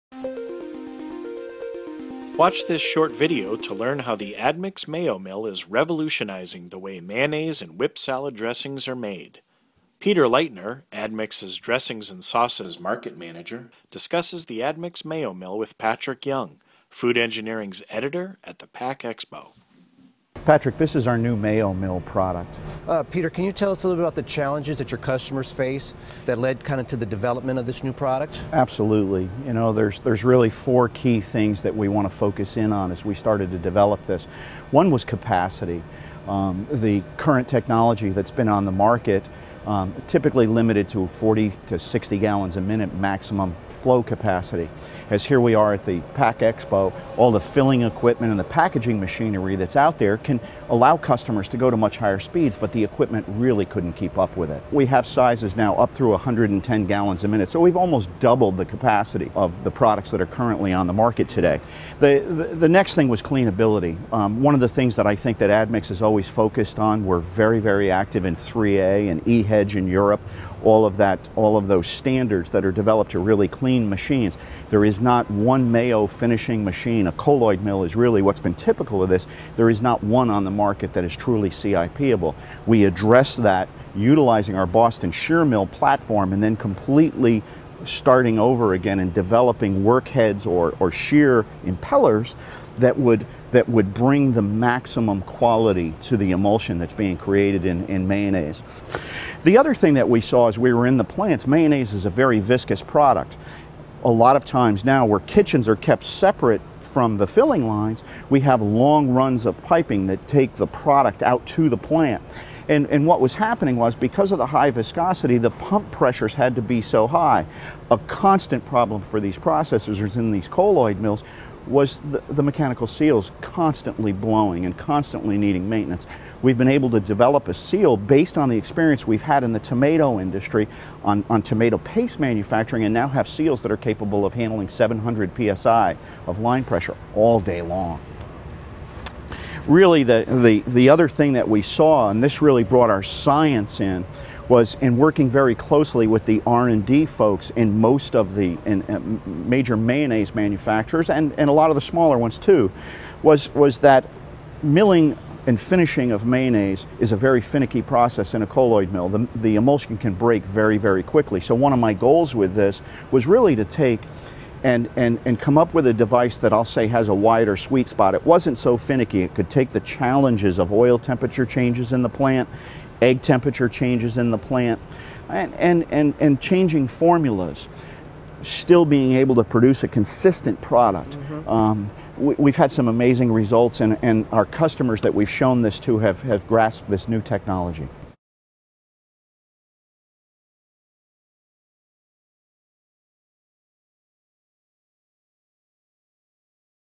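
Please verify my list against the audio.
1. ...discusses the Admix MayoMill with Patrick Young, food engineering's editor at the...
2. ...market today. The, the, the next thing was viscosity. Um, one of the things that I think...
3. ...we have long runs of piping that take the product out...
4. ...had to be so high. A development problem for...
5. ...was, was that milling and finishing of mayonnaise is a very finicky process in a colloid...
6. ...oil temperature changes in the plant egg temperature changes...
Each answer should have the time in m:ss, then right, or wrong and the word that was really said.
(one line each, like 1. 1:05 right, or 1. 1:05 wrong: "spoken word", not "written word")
1. 0:13 right
2. 1:00 wrong: "cleanability", not "viscosity"
3. 1:48 right
4. 1:56 wrong: "constant", not "development"
5. 2:33 right
6. 2:50 right.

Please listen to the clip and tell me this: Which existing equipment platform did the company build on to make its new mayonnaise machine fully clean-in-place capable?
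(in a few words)
Boston Shearmill.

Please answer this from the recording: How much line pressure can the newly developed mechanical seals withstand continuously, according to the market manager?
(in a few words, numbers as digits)
700 psi.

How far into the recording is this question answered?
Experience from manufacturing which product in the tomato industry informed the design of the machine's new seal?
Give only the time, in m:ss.
2:11.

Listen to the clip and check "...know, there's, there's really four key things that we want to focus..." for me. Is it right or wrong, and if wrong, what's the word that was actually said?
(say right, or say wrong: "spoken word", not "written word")
right.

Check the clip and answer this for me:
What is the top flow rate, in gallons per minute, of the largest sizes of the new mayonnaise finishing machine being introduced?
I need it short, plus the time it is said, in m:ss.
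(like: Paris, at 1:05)
110 gallons a minute, at 0:56.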